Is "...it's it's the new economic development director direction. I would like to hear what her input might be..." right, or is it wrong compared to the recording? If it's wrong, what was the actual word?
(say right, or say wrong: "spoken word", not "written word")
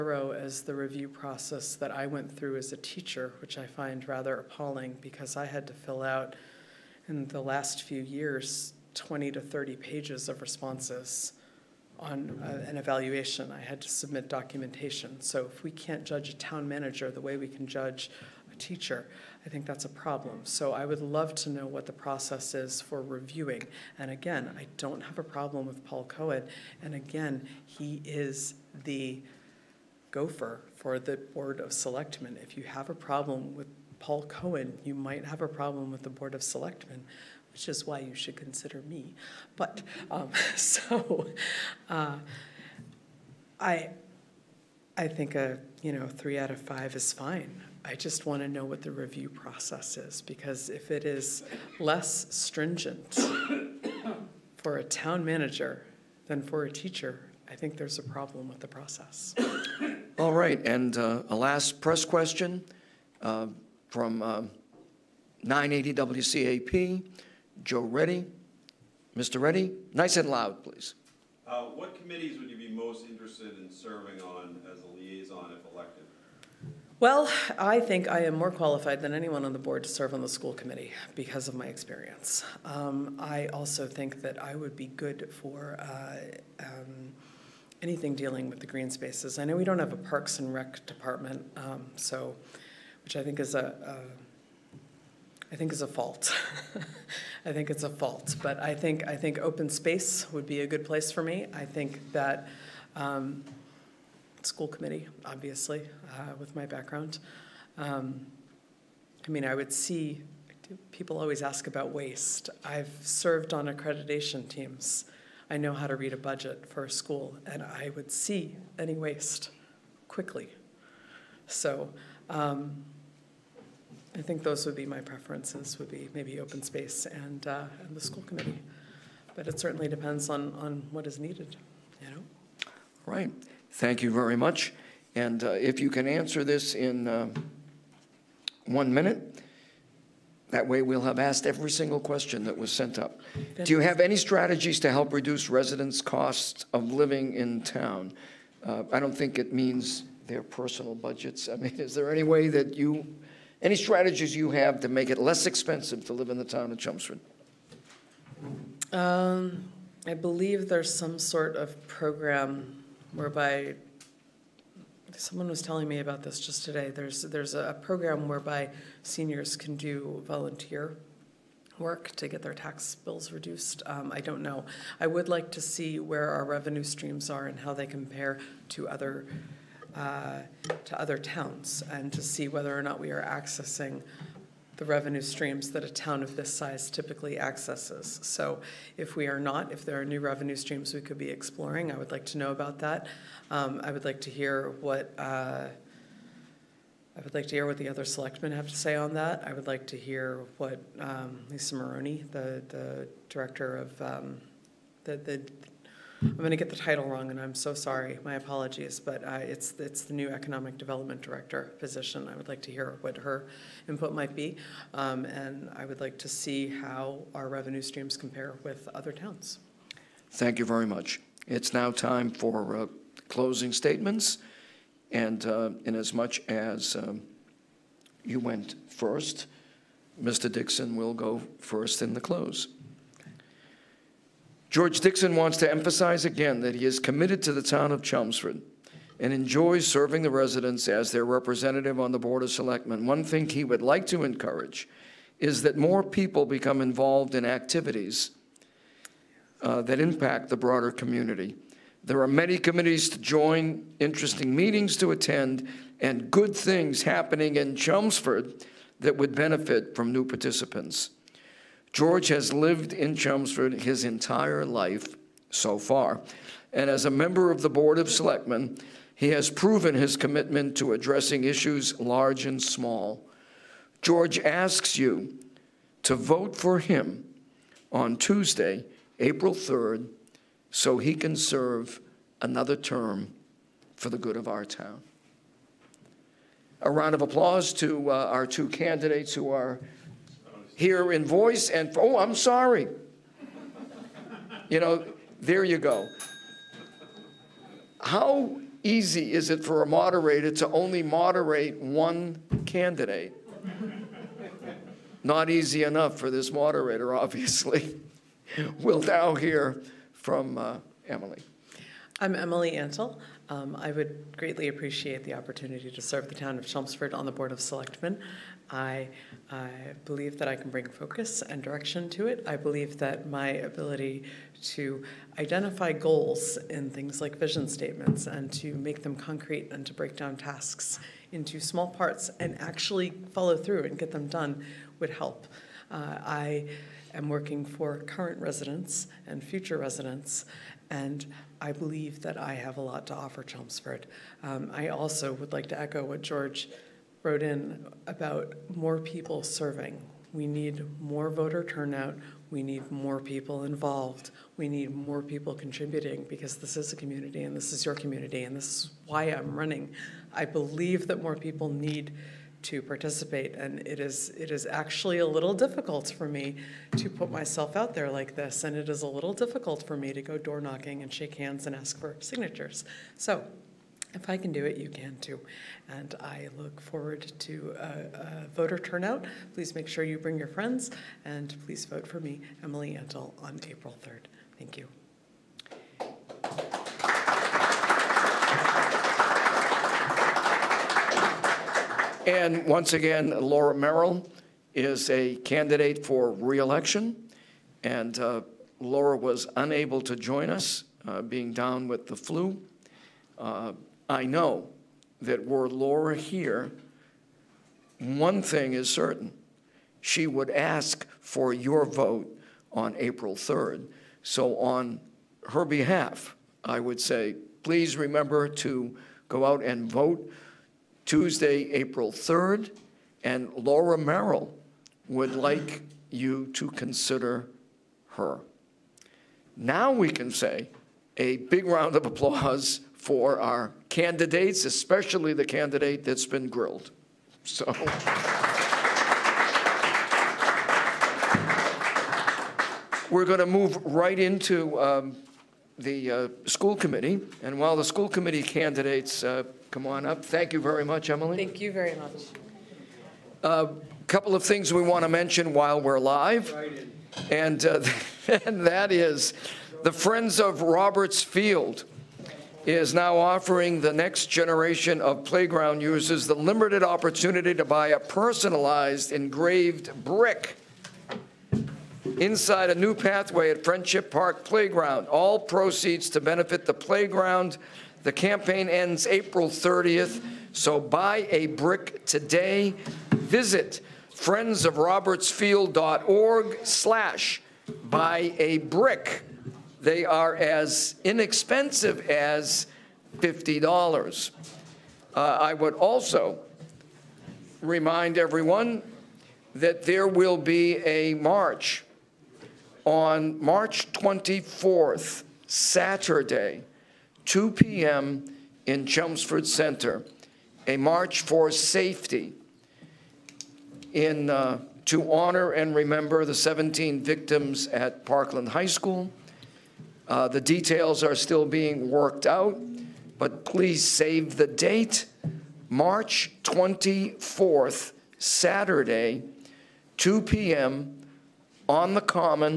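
wrong: "position", not "direction".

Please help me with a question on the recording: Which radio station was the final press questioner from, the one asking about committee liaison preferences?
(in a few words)
980 WCAP.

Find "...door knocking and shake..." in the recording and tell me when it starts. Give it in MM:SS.
06:10.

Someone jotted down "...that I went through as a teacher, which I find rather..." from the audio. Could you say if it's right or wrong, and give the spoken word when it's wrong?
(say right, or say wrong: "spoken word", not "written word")
right.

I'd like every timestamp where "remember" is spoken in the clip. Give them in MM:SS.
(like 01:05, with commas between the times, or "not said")
06:57, 08:35.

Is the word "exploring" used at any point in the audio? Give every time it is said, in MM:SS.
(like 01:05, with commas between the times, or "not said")
03:11.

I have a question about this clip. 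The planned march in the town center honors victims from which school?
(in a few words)
Parkland High School.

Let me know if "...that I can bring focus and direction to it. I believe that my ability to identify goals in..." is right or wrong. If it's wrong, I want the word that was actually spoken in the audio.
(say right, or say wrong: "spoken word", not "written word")
right.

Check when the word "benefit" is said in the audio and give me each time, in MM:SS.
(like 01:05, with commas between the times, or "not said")
04:19, 07:56.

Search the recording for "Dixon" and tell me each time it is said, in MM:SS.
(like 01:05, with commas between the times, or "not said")
03:50, 03:54.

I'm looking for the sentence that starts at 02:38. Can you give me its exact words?
Um, I believe there's some sort of program whereby someone was telling me about this just today.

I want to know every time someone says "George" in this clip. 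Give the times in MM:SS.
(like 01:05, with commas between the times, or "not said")
03:54, 04:21, 04:34, 05:46.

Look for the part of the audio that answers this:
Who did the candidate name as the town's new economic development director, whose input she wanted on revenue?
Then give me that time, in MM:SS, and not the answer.
03:21.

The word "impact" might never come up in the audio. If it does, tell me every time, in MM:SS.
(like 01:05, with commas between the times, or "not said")
04:09.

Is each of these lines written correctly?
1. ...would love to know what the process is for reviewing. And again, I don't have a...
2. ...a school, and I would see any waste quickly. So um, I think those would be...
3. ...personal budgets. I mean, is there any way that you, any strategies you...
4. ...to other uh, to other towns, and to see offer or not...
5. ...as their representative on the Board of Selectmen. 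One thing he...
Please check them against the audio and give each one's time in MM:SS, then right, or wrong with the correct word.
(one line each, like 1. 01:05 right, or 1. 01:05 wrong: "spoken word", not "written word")
1. 00:20 right
2. 01:56 right
3. 02:30 right
4. 02:58 wrong: "whether", not "offer"
5. 04:00 right.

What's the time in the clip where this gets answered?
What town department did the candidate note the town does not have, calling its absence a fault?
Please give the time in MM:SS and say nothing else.
01:29.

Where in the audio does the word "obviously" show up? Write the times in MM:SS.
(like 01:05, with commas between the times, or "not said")
01:45, 05:07.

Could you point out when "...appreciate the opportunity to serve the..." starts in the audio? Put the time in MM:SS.
05:14.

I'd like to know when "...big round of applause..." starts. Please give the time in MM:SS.
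07:11.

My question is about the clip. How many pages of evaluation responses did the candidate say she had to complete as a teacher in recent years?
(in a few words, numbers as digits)
20 to 30.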